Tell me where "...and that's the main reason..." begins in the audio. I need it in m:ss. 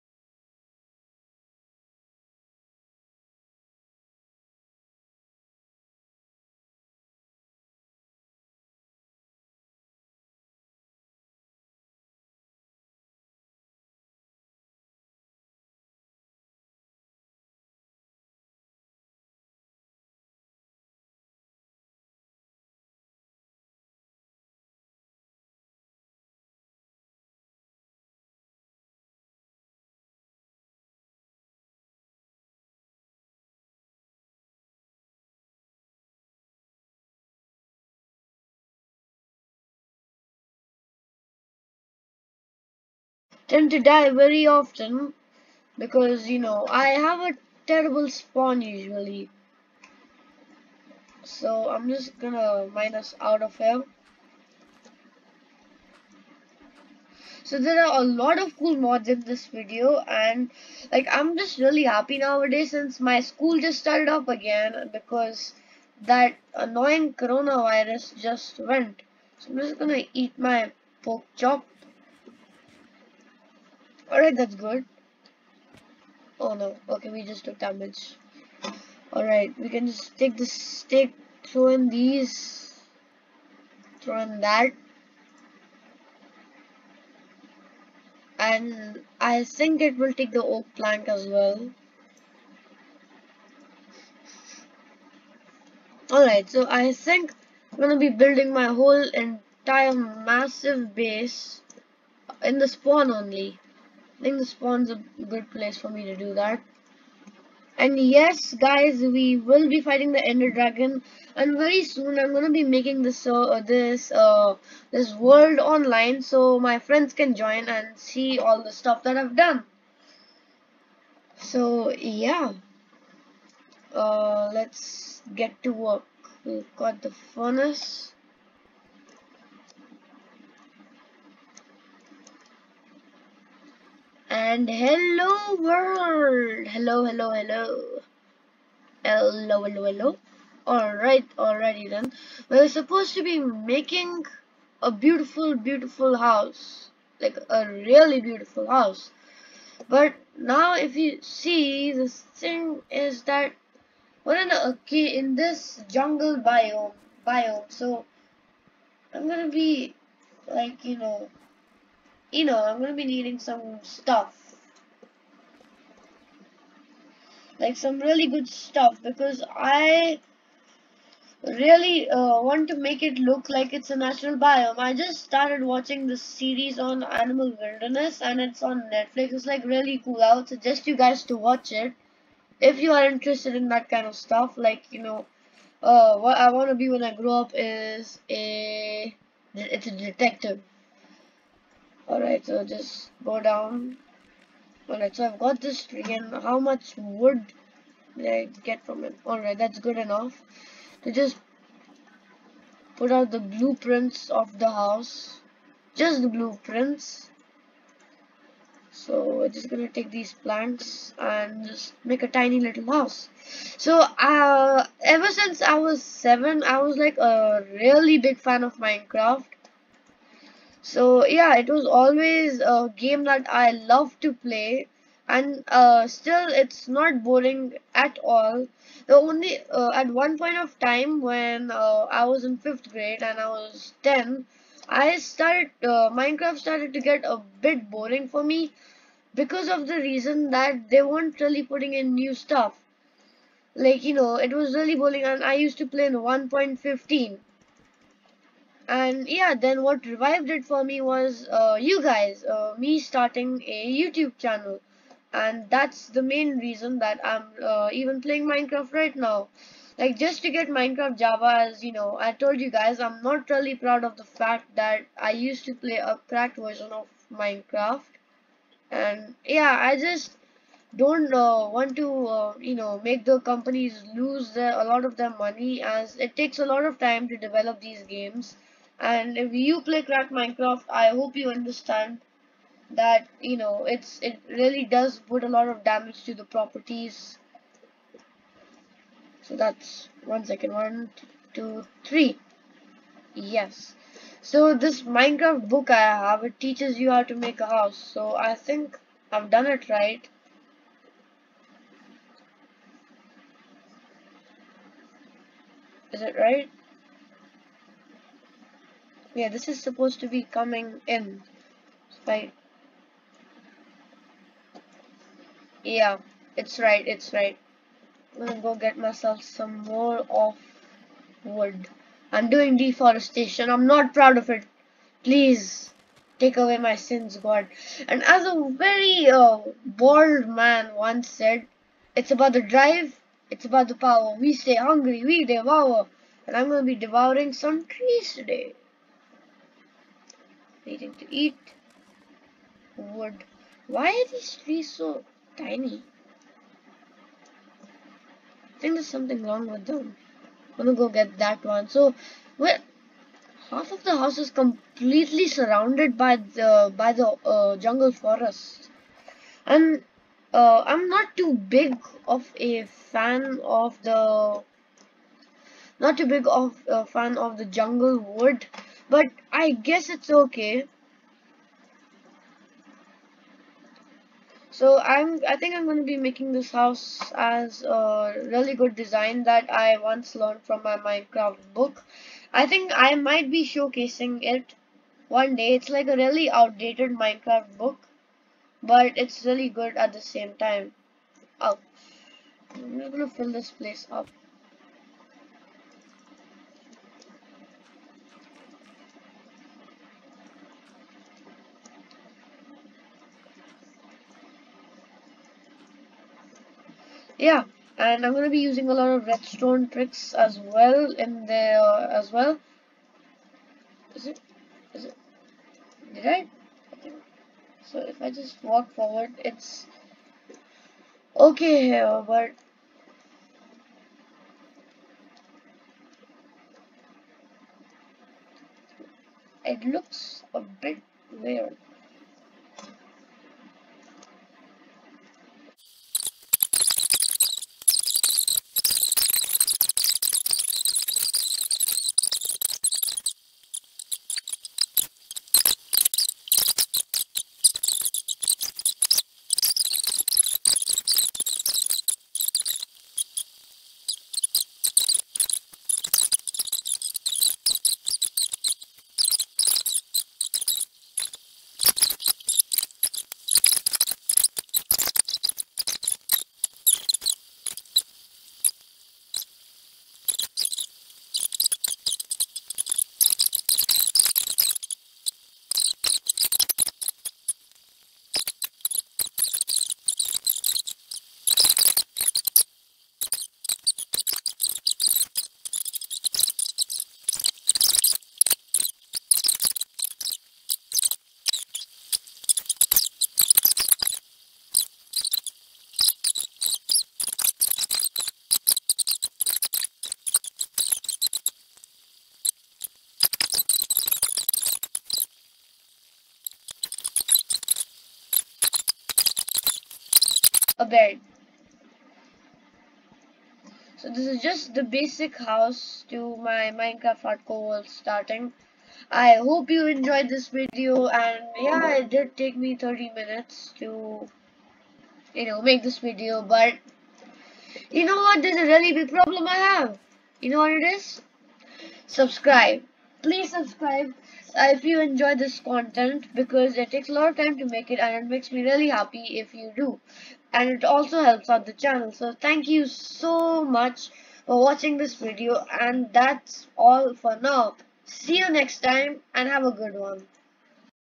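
4:15.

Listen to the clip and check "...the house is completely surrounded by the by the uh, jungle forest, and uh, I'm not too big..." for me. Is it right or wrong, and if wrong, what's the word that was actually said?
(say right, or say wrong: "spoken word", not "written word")
right.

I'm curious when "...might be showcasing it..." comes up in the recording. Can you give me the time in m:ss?
6:23.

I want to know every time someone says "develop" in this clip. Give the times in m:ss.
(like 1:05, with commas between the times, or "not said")
4:37.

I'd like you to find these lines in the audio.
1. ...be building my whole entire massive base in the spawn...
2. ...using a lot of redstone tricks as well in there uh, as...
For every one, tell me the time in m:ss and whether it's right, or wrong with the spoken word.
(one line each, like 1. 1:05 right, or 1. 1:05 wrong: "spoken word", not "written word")
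1. 1:37 right
2. 6:48 right.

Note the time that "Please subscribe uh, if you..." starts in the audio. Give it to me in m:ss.
8:53.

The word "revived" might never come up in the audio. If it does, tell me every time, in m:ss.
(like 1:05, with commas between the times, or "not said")
4:10.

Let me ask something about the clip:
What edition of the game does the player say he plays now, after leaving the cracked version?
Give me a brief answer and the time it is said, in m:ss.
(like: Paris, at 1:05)
Minecraft Java, at 4:20.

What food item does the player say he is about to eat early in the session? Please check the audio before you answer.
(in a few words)
Pork chop.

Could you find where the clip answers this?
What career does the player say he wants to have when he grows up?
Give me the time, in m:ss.
3:09.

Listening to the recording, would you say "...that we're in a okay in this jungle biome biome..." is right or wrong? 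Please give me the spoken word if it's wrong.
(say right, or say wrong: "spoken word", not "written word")
right.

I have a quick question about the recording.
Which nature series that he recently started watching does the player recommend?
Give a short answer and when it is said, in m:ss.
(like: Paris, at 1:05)
Animal wilderness, at 2:57.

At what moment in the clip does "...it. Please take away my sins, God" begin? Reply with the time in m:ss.
5:24.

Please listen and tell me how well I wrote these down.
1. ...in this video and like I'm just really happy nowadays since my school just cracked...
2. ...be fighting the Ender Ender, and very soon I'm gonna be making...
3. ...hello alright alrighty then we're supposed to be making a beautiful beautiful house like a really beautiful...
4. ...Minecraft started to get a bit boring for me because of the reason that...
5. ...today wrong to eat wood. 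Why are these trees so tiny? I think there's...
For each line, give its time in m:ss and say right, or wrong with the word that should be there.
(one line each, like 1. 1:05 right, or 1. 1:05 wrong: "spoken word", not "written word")
1. 0:59 wrong: "started", not "cracked"
2. 1:49 wrong: "Dragon", not "Ender"
3. 2:19 right
4. 3:56 right
5. 5:38 wrong: "needing", not "wrong".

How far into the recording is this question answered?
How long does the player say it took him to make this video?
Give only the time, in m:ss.
8:42.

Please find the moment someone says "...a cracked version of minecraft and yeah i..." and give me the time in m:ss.
4:26.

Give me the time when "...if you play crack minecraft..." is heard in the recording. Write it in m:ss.
4:39.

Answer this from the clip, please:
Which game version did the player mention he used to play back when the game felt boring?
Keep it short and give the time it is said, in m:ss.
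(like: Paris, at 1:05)
1.15, at 4:06.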